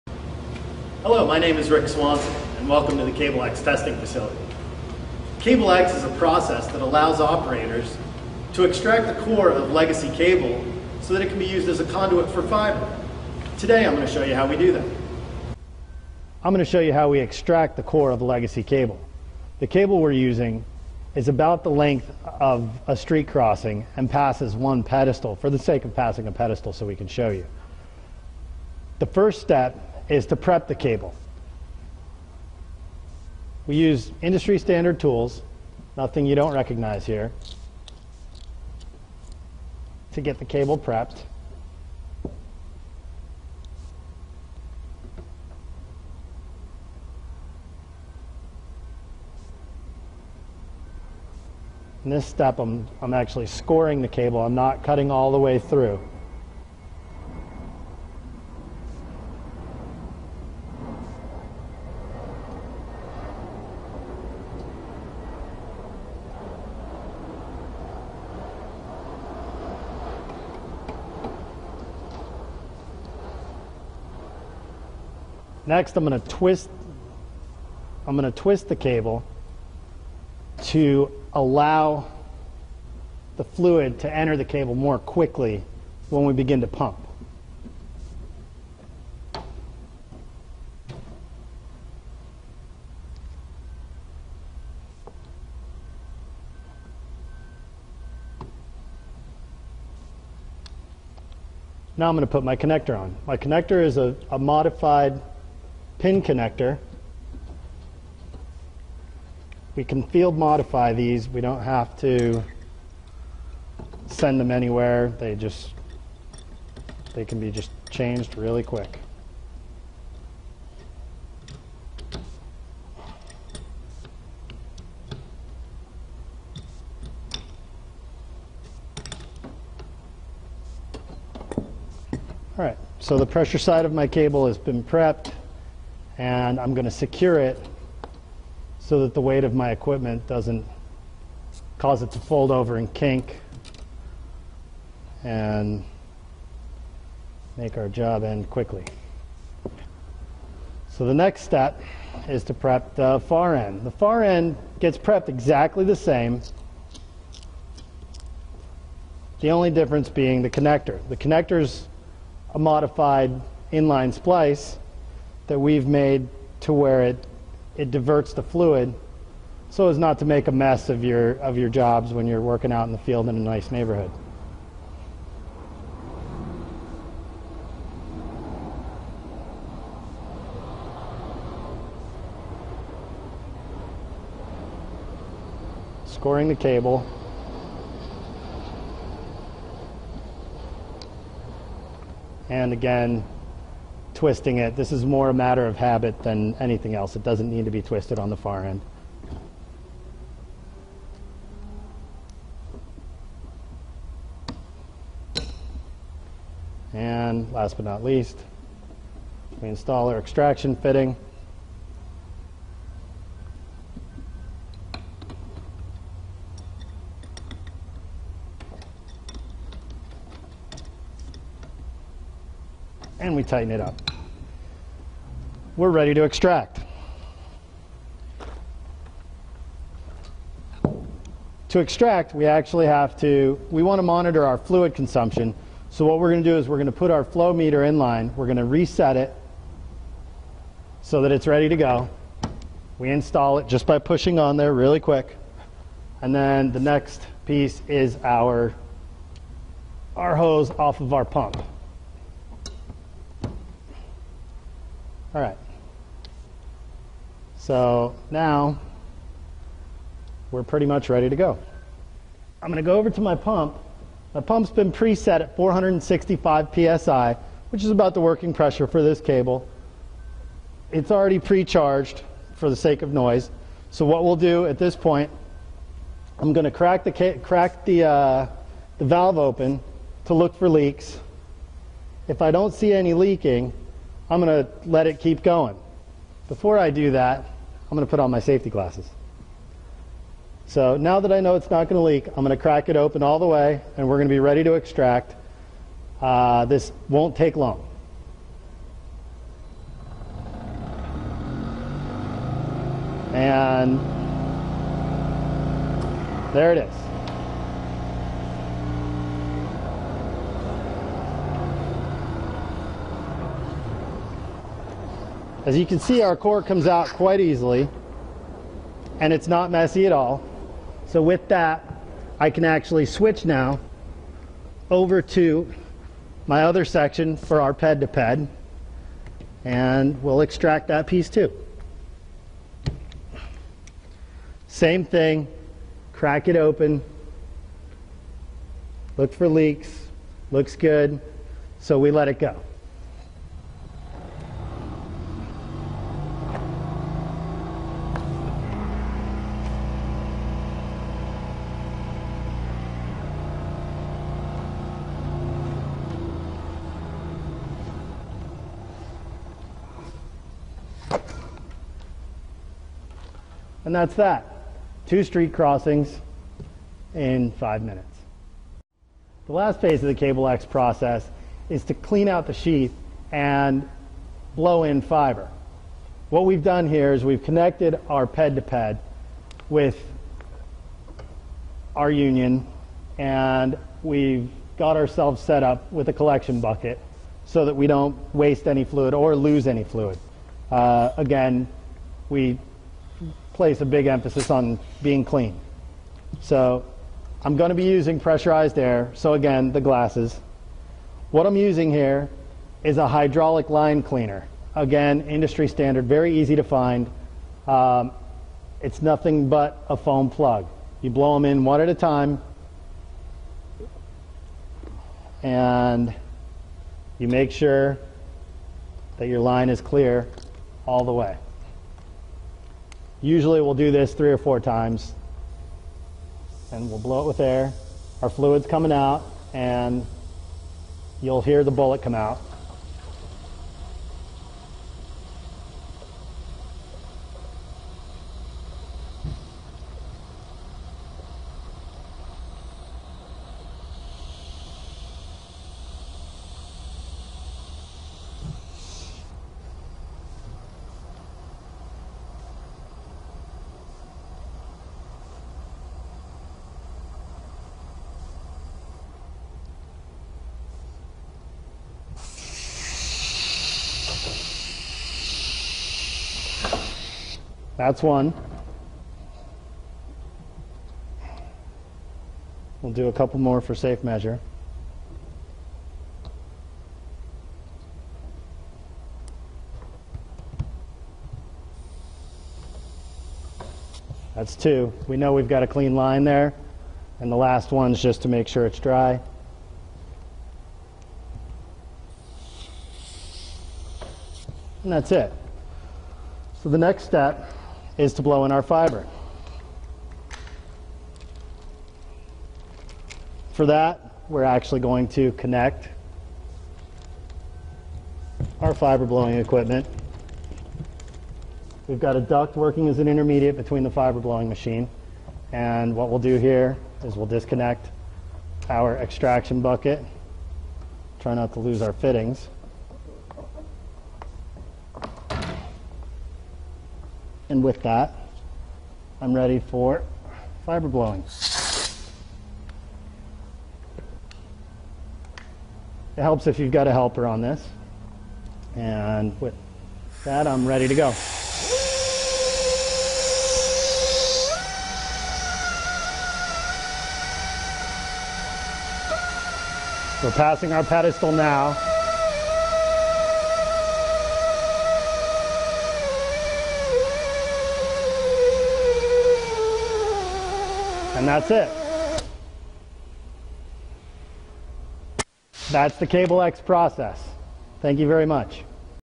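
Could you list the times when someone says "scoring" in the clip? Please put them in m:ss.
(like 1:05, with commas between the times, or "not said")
0:53, 3:06.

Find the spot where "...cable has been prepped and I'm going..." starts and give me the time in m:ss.
2:14.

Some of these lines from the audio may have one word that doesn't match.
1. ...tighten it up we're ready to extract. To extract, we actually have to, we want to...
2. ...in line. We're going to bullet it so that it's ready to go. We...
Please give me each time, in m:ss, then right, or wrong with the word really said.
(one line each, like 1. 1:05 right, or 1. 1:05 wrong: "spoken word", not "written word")
1. 3:43 right
2. 3:57 wrong: "reset", not "bullet".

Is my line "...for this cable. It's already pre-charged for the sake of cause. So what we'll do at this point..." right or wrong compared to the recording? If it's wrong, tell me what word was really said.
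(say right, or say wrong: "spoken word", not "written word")
wrong: "noise", not "cause".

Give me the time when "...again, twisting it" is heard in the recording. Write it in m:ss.
3:12.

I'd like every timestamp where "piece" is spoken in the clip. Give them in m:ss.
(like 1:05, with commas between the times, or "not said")
4:07, 5:31.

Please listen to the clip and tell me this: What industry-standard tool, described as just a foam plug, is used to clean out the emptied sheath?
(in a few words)
hydraulic line cleaner.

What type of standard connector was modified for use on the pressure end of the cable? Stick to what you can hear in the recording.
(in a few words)
pin connector.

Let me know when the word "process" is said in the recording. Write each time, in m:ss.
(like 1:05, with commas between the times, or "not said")
0:06, 6:10, 9:26.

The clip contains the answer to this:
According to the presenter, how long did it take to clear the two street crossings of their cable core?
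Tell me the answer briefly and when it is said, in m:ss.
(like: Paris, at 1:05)
5 minutes, at 6:07.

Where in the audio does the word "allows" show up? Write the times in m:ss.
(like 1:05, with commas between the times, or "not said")
0:06, 1:21.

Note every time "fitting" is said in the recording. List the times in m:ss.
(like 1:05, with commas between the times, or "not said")
3:30, 8:41.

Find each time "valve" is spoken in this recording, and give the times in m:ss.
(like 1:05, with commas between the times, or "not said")
4:39.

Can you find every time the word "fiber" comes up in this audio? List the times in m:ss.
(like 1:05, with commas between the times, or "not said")
0:12, 6:15, 8:18, 8:28, 8:33, 8:50.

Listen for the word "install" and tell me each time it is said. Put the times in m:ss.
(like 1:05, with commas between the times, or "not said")
3:29, 4:03.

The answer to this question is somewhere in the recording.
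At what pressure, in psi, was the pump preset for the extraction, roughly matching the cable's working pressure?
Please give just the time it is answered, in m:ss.
4:25.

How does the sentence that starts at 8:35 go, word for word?
And what we'll do here is we'll disconnect our extraction bucket.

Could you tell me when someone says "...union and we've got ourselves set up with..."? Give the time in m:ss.
6:22.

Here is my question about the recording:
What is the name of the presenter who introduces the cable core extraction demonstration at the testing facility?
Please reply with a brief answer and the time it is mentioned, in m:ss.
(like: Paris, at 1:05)
Rick Swanson, at 0:01.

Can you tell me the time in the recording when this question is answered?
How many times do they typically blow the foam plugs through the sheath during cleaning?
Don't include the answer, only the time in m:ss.
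7:04.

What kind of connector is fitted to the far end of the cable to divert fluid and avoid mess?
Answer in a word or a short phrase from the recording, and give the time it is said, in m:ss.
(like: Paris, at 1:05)
modified inline splice, at 2:42.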